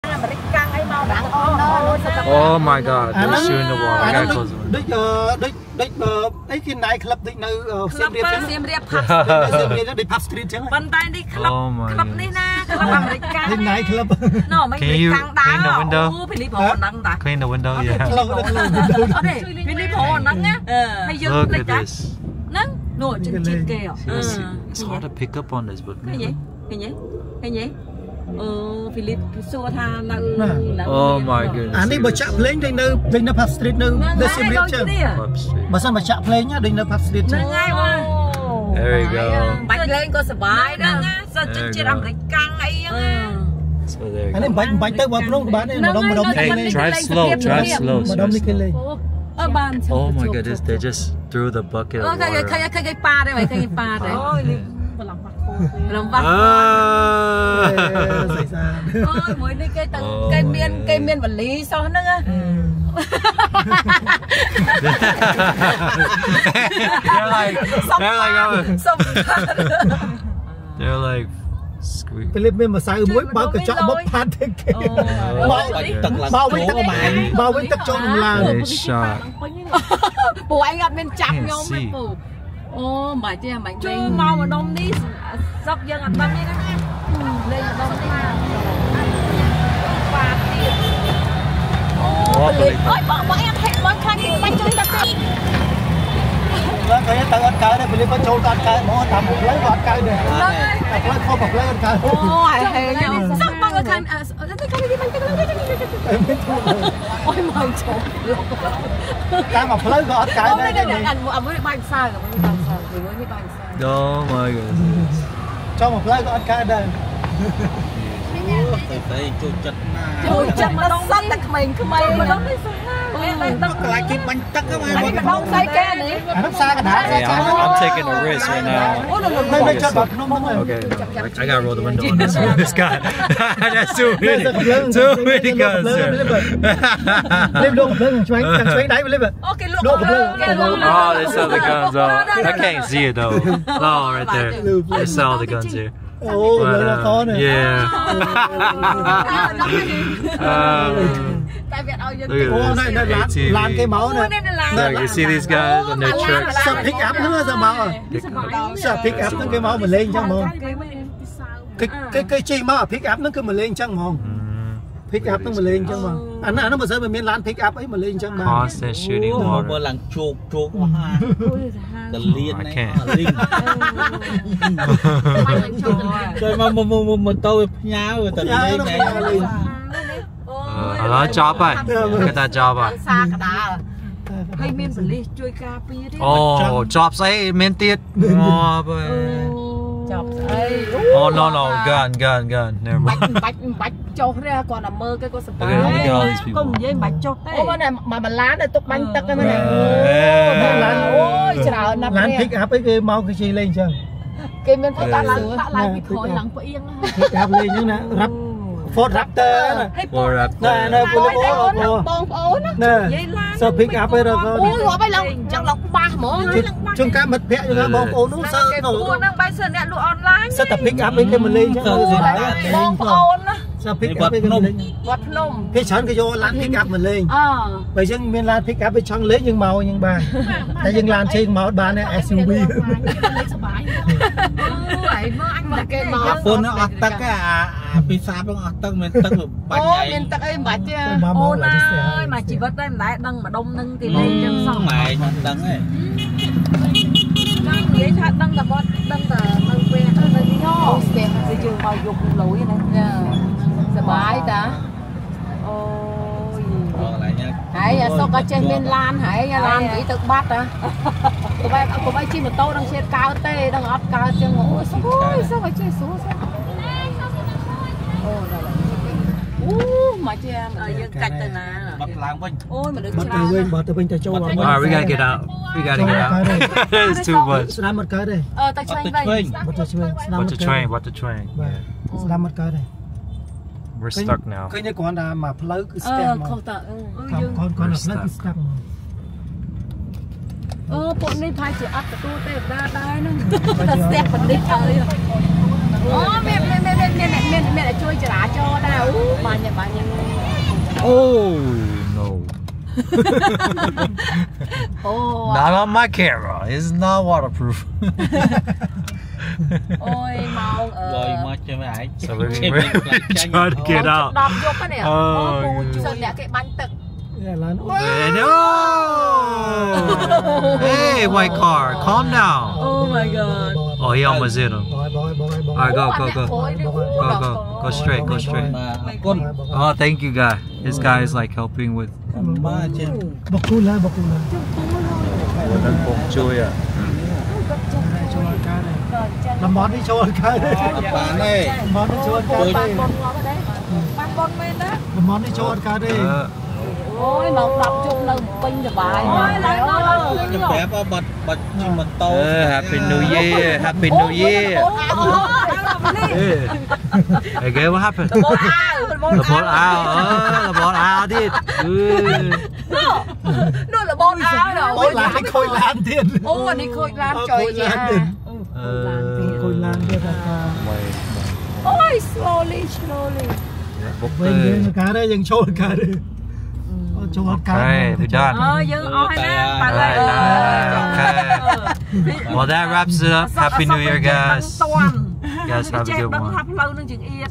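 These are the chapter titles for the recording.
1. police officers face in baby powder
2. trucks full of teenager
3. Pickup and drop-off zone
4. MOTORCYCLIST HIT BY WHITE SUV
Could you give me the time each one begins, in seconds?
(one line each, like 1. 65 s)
1. 88 s
2. 158 s
3. 200 s
4. 320 s.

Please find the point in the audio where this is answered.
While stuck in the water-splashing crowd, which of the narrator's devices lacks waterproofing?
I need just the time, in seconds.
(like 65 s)
305 s.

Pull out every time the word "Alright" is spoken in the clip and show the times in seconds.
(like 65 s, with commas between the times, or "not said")
325 s.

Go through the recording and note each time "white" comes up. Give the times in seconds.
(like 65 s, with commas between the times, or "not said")
321 s.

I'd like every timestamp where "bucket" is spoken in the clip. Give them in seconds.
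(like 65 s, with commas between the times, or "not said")
51 s.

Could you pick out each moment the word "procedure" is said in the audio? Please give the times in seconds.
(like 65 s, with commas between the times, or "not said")
not said.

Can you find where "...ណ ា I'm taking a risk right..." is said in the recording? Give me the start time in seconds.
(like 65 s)
122 s.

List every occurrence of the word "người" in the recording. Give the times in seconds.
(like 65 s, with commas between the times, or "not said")
114 s.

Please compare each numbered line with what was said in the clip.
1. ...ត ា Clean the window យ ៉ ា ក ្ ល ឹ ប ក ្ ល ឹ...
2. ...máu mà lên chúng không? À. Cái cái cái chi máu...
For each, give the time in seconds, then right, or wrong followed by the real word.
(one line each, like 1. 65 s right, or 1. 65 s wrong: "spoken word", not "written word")
1. 17 s right
2. 159 s wrong: "chẳng", not "chúng".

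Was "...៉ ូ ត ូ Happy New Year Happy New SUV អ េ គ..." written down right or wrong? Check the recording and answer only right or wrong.
wrong.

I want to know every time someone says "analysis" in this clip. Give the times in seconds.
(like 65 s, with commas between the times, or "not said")
not said.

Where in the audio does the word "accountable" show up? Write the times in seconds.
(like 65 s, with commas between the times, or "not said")
not said.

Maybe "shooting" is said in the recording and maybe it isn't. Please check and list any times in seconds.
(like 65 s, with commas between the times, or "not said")
168 s.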